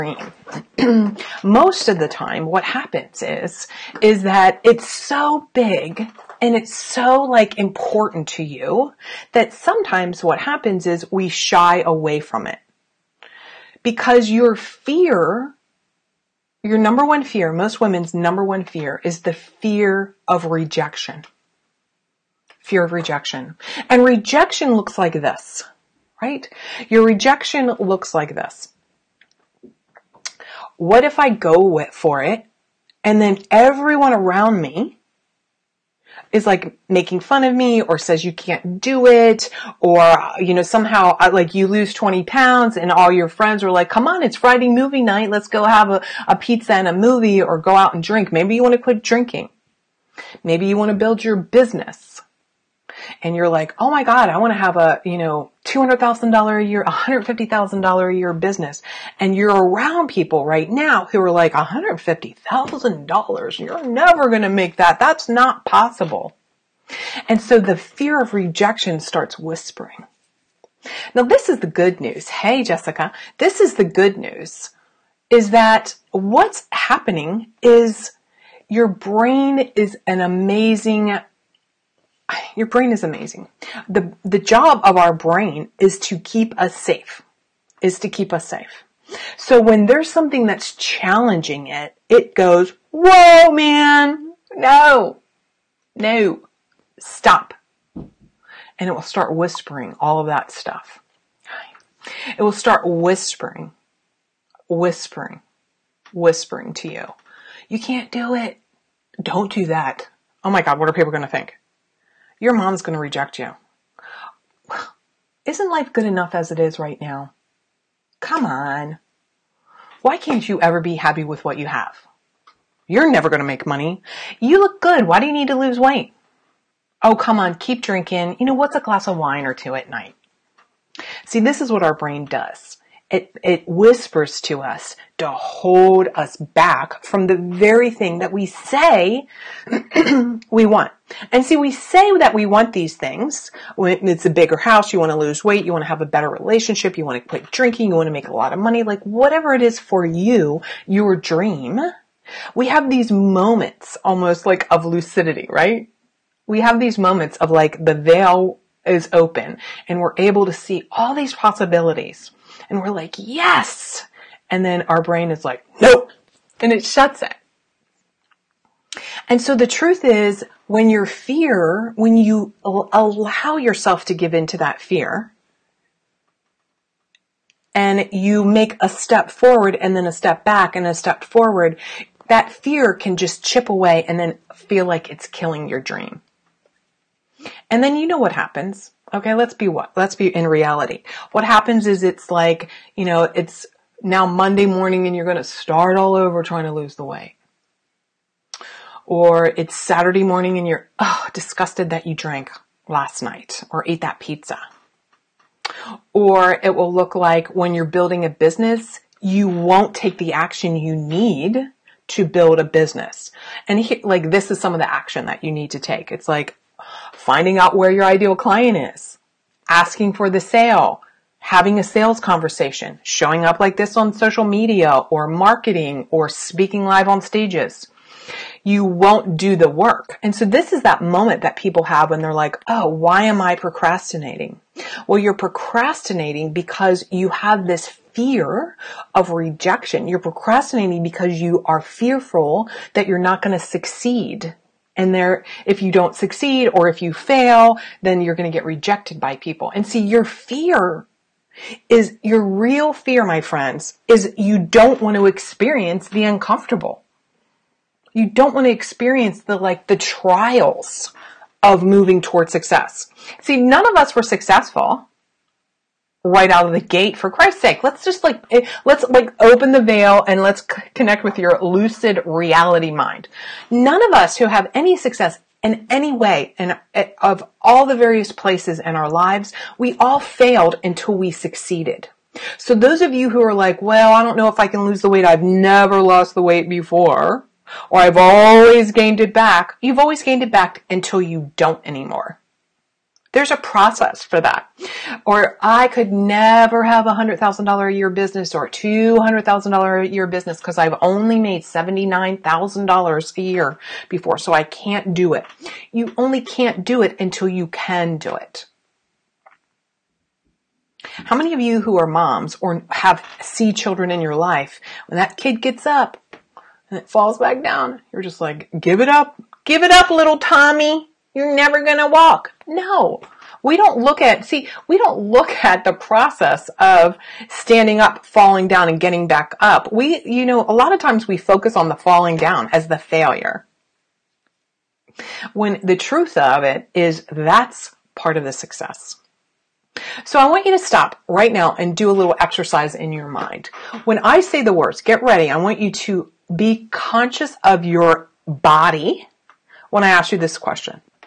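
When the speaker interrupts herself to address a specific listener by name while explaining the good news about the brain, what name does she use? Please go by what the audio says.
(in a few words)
Jessica.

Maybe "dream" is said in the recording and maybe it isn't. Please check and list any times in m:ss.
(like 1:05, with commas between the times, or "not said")
2:31, 3:05.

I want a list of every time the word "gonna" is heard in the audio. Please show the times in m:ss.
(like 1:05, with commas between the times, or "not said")
5:21.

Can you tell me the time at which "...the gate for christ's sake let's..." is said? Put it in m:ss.
4:26.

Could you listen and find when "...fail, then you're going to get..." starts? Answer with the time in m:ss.
4:07.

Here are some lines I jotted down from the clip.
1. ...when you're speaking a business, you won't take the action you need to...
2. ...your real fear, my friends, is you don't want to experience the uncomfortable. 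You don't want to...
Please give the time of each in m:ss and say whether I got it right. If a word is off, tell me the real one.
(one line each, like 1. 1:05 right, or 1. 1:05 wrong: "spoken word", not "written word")
1. 3:27 wrong: "building", not "speaking"
2. 4:12 right.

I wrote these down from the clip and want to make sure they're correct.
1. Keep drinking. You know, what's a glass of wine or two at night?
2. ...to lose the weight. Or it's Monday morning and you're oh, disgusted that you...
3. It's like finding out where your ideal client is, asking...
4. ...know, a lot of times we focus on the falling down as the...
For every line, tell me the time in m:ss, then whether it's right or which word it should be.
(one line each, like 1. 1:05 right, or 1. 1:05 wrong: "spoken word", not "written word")
1. 2:07 right
2. 3:16 wrong: "Saturday", not "Monday"
3. 3:36 right
4. 5:30 right.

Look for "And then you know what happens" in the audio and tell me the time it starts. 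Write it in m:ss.
3:07.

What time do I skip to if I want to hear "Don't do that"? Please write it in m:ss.
1:49.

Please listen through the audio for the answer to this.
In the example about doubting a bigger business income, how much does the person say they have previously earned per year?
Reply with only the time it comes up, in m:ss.
5:01.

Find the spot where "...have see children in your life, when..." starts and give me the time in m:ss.
5:12.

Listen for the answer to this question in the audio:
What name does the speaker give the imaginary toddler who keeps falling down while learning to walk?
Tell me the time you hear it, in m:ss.
5:20.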